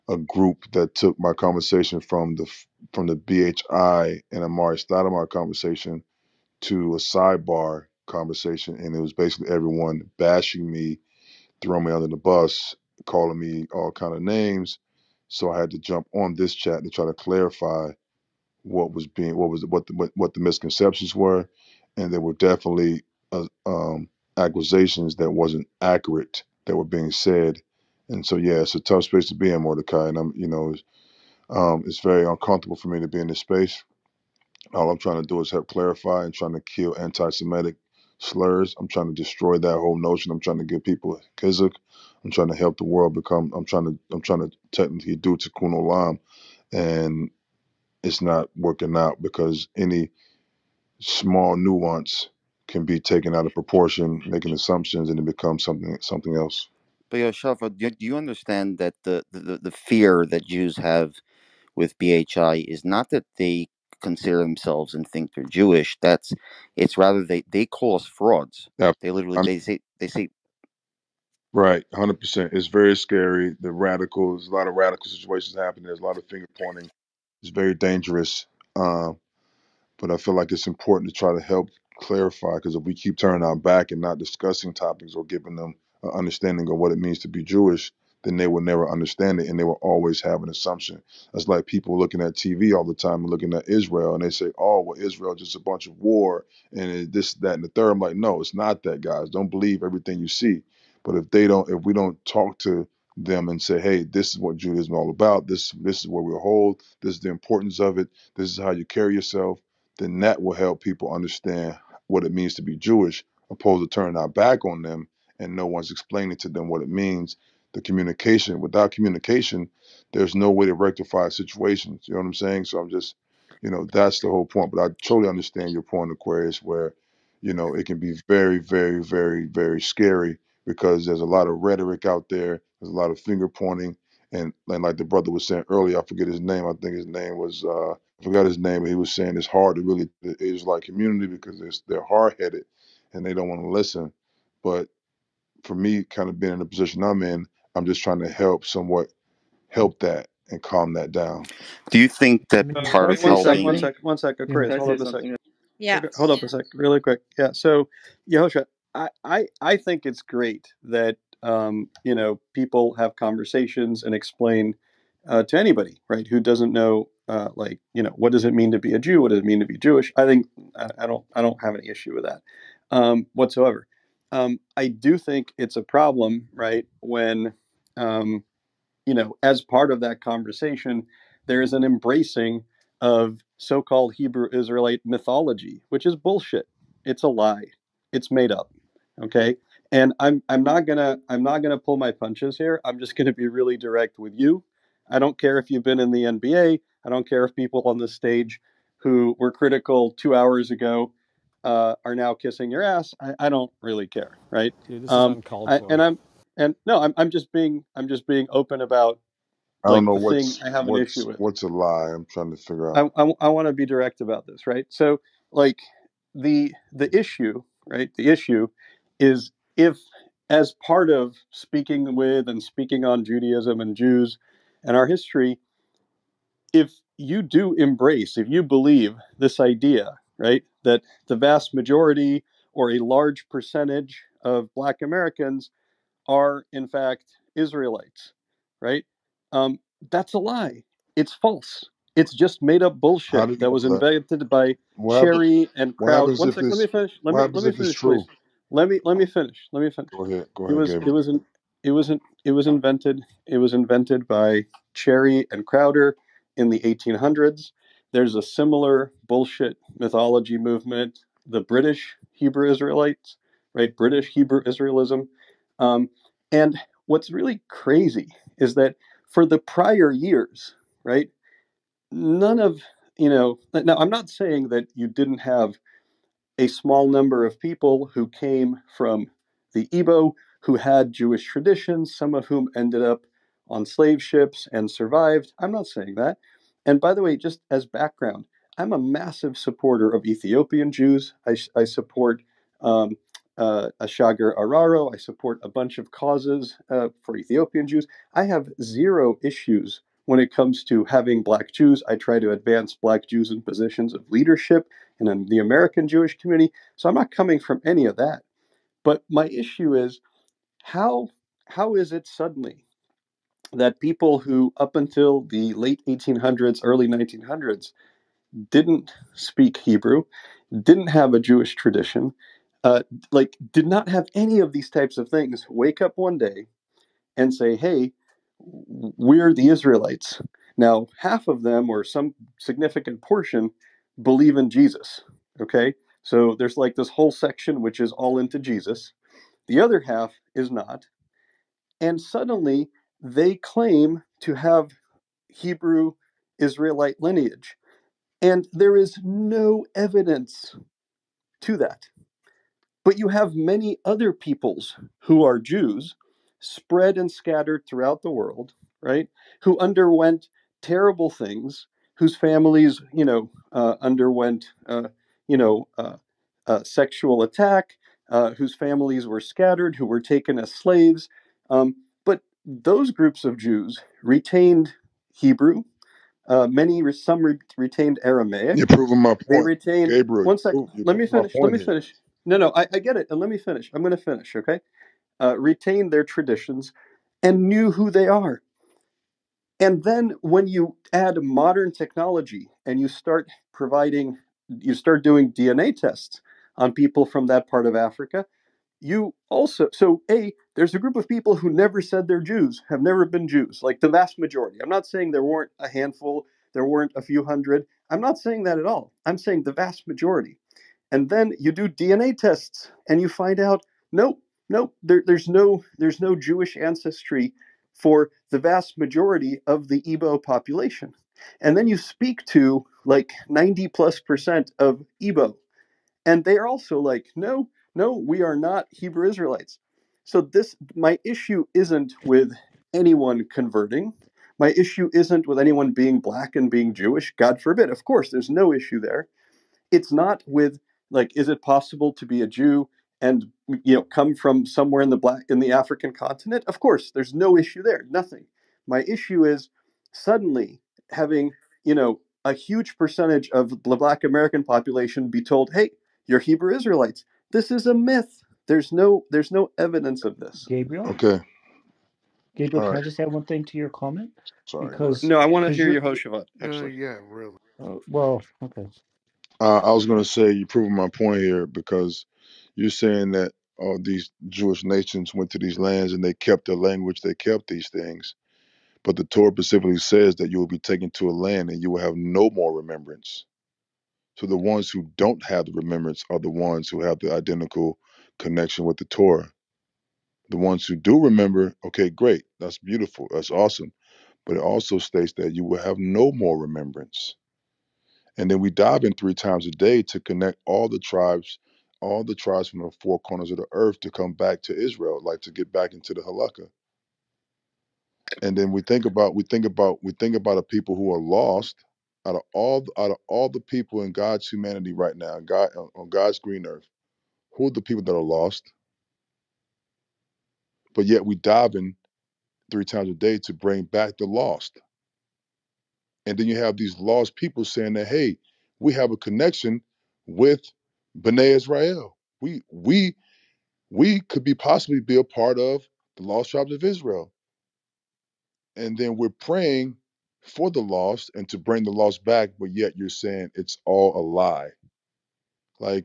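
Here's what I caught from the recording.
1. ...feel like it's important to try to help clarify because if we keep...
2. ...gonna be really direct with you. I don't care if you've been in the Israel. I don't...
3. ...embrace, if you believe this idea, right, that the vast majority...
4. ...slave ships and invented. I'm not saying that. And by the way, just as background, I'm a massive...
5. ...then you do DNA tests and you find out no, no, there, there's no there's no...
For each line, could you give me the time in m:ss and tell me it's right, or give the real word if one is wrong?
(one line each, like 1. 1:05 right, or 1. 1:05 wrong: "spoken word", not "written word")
1. 1:20 right
2. 3:13 wrong: "NBA", not "Israel"
3. 3:47 right
4. 4:43 wrong: "survived", not "invented"
5. 6:51 right.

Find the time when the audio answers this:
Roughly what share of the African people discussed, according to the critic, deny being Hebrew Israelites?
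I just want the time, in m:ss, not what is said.
7:03.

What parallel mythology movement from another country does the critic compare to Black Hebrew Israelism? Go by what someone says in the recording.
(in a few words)
British Hebrew Israelites.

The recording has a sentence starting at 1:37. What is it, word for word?
I'm like, no, it's not that, guys.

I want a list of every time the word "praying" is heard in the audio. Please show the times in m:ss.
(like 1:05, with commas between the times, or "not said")
8:59.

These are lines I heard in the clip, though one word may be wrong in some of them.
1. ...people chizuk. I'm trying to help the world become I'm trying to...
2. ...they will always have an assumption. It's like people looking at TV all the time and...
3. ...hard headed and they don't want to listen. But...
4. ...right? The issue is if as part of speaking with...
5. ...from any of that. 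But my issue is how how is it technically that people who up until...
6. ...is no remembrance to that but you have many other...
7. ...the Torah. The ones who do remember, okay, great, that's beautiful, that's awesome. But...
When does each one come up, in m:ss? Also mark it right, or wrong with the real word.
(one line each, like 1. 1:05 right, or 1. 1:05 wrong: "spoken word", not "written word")
1. 0:40 right
2. 1:29 right
3. 2:22 right
4. 3:37 right
5. 5:07 wrong: "suddenly", not "technically"
6. 5:48 wrong: "evidence", not "remembrance"
7. 8:08 right.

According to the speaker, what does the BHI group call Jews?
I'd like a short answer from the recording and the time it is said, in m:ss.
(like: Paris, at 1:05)
frauds, at 1:08.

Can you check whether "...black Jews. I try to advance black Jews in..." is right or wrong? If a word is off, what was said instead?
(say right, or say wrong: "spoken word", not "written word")
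right.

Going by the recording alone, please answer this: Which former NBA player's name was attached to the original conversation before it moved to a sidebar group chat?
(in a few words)
Amar'e Stoudemire.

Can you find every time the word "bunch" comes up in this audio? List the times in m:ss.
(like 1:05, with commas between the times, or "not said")
1:35, 4:55.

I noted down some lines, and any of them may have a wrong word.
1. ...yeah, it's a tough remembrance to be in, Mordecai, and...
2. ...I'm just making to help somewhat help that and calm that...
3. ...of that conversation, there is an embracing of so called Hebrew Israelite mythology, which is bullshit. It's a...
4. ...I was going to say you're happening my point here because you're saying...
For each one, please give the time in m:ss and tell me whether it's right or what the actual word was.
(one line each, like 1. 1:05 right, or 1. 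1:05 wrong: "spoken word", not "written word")
1. 0:28 wrong: "space", not "remembrance"
2. 2:27 wrong: "trying", not "making"
3. 2:59 right
4. 7:49 wrong: "proving", not "happening".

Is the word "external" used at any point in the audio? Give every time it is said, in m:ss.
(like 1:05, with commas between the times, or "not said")
not said.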